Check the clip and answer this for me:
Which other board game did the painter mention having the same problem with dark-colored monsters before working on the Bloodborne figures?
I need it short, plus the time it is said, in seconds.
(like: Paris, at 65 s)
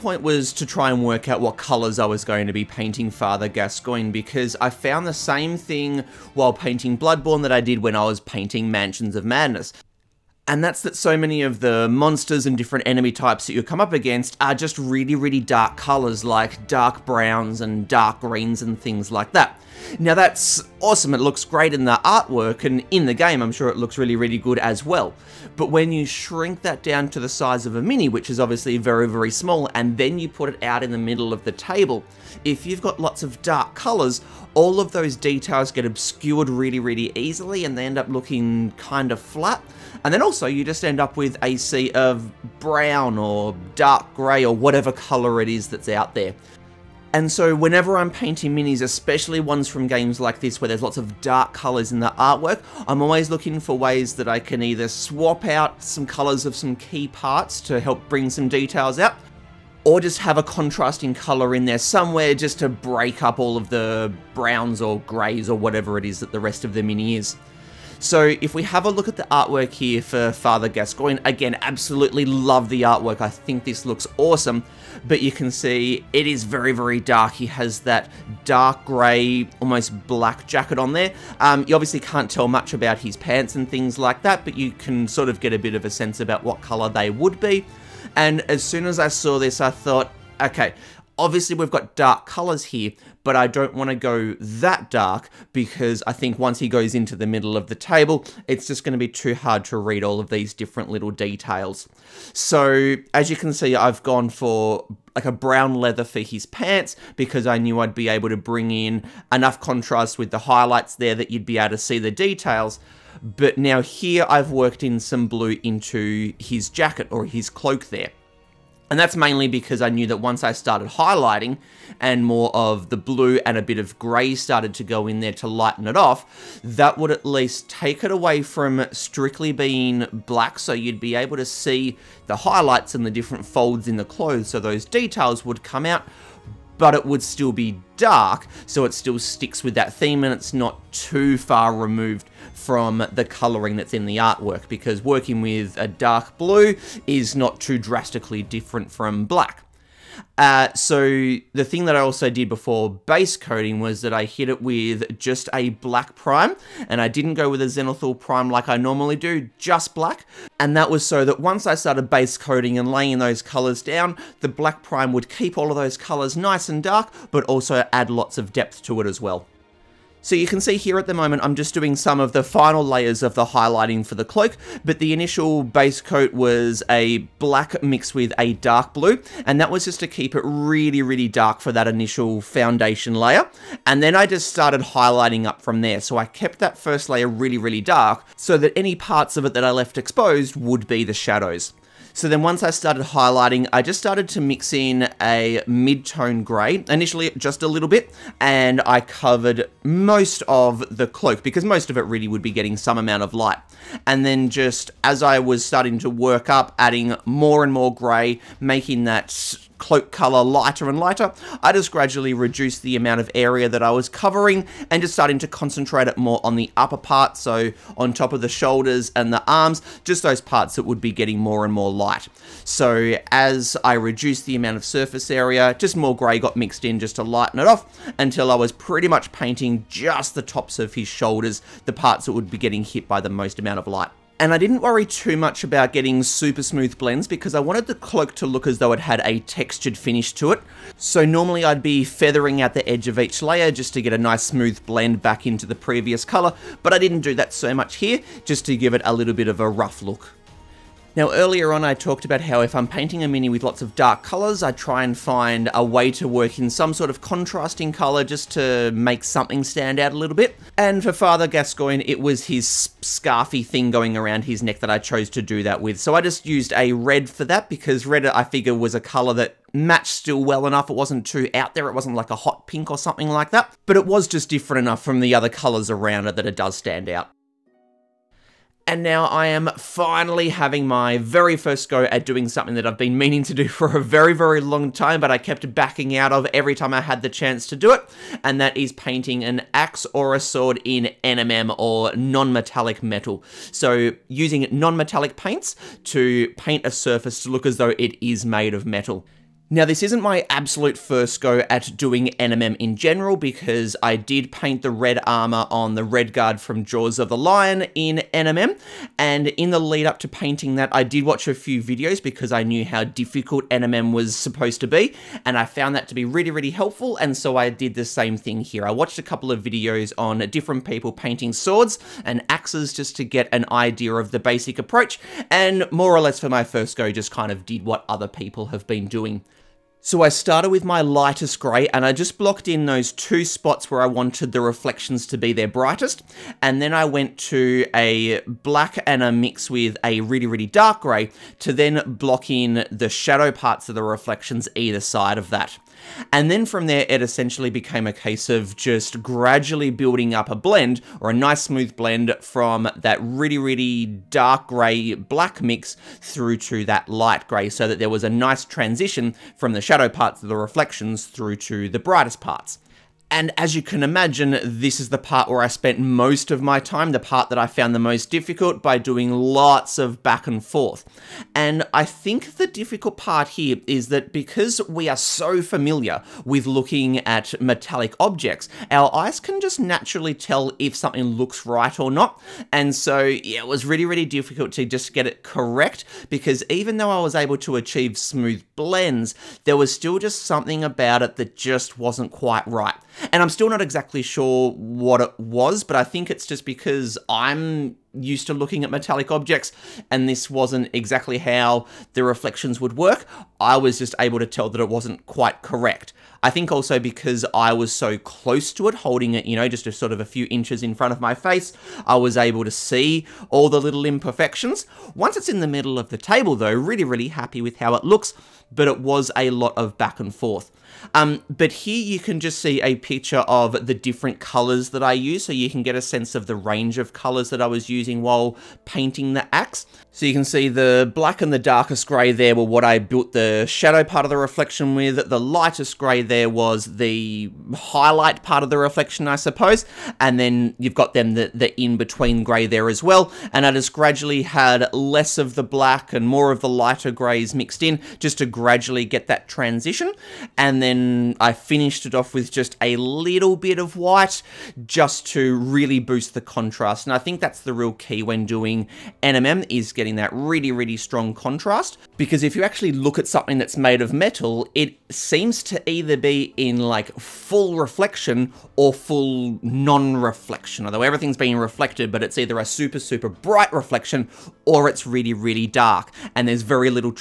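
Mansions of Madness, at 8 s.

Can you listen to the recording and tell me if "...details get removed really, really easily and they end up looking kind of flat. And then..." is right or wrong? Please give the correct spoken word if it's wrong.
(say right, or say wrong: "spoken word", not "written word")
wrong: "obscured", not "removed".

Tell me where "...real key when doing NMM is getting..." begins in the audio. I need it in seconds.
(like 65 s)
457 s.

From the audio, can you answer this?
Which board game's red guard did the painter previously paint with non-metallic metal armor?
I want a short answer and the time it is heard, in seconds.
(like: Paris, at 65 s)
Jaws of the Lion, at 306 s.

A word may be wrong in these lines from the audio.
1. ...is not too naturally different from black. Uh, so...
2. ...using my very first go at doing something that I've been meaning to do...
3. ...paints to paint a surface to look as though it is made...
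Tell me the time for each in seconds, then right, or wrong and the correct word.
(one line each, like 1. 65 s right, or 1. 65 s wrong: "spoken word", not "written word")
1. 147 s wrong: "drastically", not "naturally"
2. 280 s wrong: "having", not "using"
3. 295 s right.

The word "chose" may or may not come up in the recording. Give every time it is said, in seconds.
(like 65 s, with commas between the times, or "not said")
264 s.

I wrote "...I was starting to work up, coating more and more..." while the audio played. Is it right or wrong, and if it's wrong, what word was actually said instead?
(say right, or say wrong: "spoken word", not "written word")
wrong: "adding", not "coating".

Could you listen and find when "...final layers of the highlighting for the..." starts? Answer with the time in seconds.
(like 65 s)
172 s.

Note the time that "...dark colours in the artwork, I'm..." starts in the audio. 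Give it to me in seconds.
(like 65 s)
51 s.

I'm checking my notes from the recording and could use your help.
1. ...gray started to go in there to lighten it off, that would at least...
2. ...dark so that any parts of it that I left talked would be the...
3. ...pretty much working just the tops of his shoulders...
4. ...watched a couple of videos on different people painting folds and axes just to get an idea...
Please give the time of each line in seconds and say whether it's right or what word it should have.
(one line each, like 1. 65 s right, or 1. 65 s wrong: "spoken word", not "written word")
1. 123 s right
2. 187 s wrong: "exposed", not "talked"
3. 228 s wrong: "painting", not "working"
4. 318 s wrong: "swords", not "folds".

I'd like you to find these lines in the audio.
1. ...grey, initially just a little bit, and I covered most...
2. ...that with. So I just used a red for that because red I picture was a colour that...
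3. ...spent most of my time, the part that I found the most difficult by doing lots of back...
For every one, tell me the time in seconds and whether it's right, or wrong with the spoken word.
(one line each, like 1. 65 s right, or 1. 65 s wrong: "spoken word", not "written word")
1. 196 s right
2. 265 s wrong: "figure", not "picture"
3. 365 s right.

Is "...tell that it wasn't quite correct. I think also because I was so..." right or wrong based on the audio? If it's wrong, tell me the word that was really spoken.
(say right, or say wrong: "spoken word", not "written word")
right.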